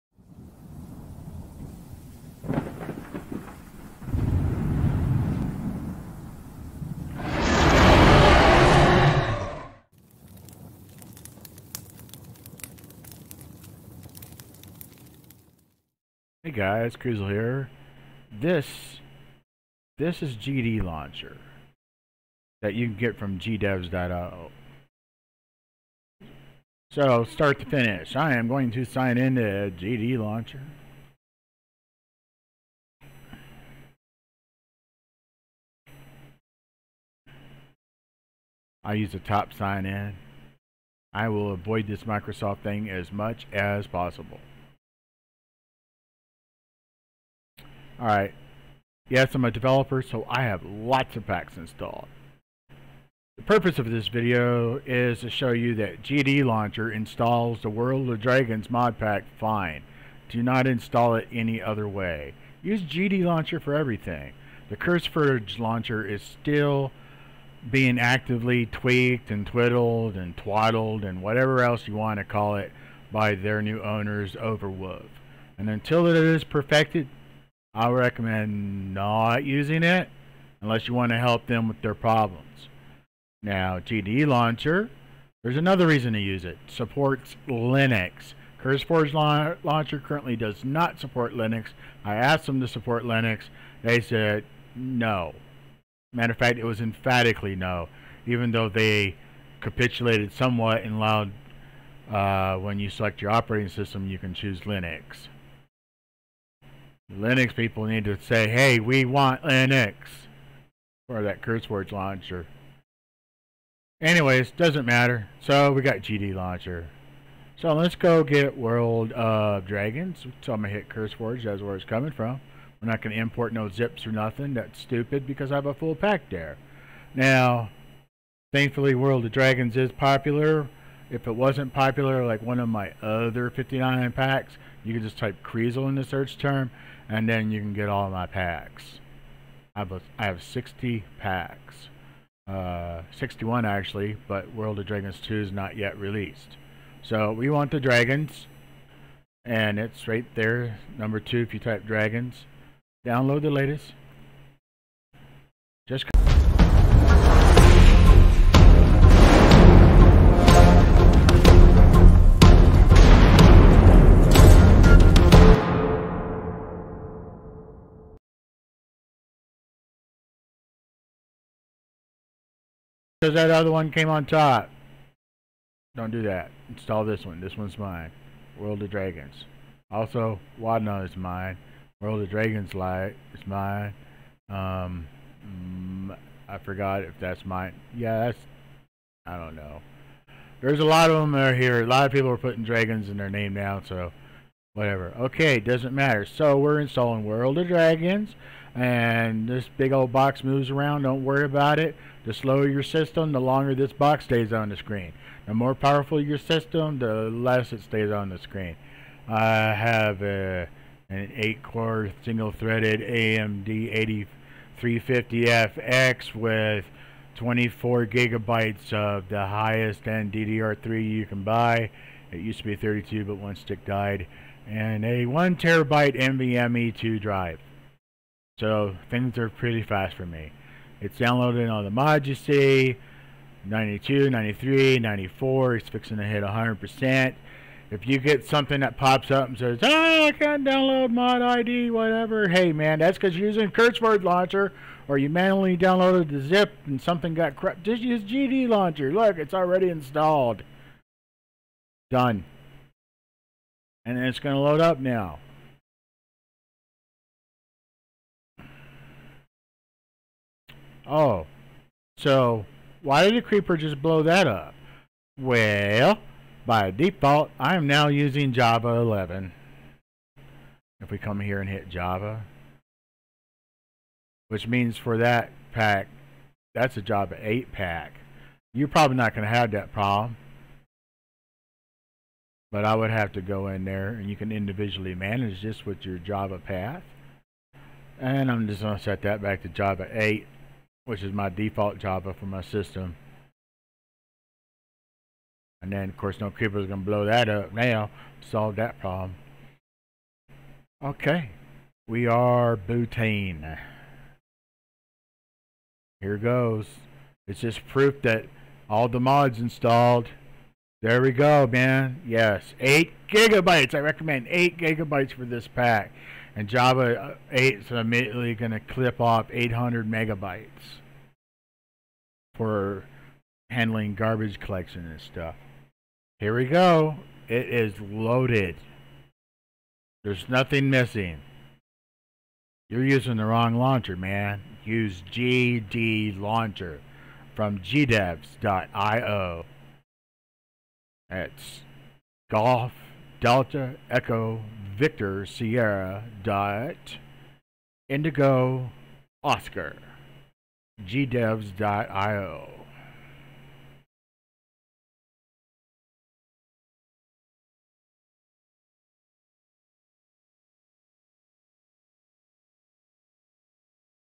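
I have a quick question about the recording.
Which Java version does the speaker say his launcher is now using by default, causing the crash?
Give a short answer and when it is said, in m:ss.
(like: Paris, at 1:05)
Java 11, at 4:28.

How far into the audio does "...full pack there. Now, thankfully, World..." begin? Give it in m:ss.
2:05.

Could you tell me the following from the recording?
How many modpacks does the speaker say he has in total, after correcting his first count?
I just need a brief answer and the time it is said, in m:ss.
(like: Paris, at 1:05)
61, at 2:23.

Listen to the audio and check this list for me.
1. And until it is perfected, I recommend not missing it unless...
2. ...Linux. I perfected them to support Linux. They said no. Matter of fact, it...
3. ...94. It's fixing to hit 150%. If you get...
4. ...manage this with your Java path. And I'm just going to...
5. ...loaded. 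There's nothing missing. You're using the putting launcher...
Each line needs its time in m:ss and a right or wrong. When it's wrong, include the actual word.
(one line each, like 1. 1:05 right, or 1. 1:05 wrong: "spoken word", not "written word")
1. 1:15 wrong: "using", not "missing"
2. 1:31 wrong: "asked", not "perfected"
3. 3:54 wrong: "100", not "150"
4. 4:45 right
5. 5:27 wrong: "wrong", not "putting".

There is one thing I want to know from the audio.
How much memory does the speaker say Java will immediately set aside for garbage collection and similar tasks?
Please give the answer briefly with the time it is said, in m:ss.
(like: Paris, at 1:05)
800 megabytes, at 5:19.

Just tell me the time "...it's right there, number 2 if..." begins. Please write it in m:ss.
2:29.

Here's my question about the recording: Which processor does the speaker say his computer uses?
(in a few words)
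AMD 8350FX.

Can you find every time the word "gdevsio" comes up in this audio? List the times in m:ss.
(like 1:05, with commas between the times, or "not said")
0:23, 5:37, 5:51.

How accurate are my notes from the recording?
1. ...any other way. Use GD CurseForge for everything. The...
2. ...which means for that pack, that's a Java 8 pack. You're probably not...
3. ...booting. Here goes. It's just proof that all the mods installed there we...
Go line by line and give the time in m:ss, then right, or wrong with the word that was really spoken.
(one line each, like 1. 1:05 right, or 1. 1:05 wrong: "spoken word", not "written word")
1. 1:01 wrong: "Launcher", not "CurseForge"
2. 4:34 right
3. 5:02 right.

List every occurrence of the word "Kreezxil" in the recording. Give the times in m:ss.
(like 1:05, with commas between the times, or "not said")
0:16, 2:15.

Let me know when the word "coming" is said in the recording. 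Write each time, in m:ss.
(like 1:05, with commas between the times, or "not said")
2:01.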